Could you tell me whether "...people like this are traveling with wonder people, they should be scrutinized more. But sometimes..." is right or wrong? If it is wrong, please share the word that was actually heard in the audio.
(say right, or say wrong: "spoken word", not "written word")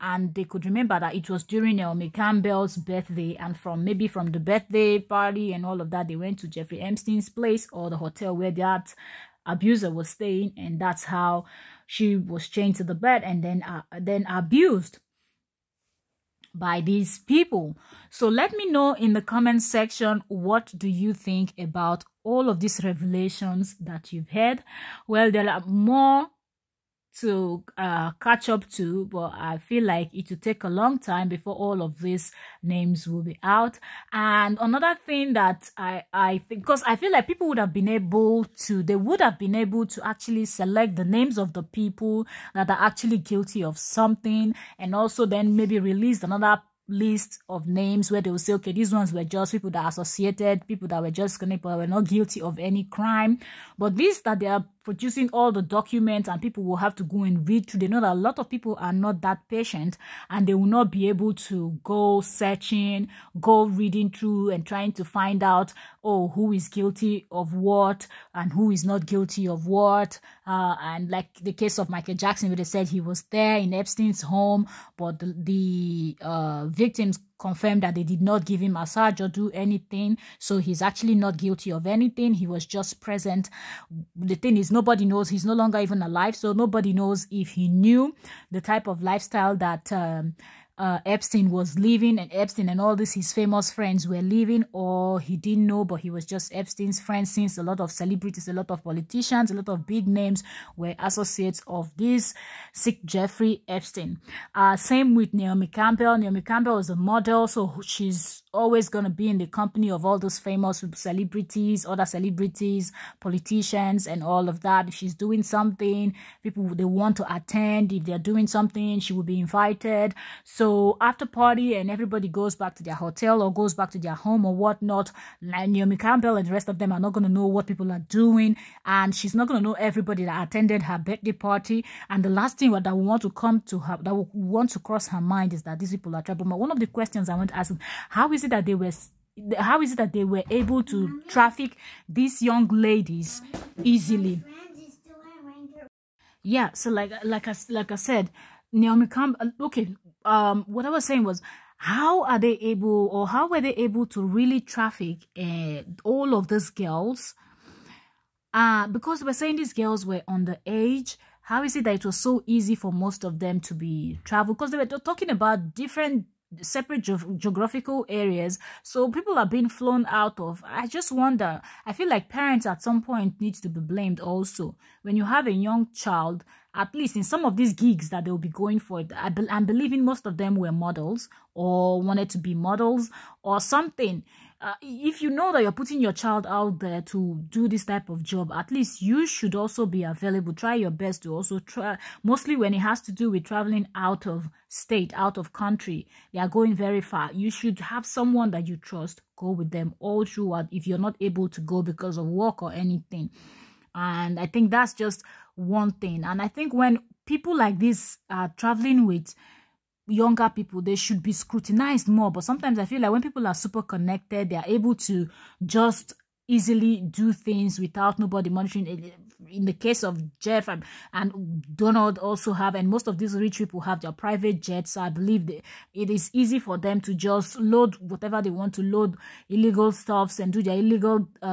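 wrong: "younger", not "wonder".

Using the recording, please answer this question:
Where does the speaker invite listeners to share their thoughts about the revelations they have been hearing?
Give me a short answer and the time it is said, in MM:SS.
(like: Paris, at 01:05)
comment section, at 00:19.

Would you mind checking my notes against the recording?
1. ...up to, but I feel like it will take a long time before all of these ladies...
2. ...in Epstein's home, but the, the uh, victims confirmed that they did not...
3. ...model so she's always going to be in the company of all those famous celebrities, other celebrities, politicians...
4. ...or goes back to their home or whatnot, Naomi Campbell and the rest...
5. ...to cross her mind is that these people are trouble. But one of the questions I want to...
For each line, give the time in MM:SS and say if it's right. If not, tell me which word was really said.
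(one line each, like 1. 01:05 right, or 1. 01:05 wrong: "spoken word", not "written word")
1. 00:28 wrong: "names", not "ladies"
2. 01:13 right
3. 01:46 right
4. 02:03 right
5. 02:14 right.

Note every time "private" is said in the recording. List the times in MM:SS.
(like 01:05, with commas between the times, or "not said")
03:44.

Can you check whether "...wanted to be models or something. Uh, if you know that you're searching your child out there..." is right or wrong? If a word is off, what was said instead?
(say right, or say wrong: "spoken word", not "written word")
wrong: "putting", not "searching".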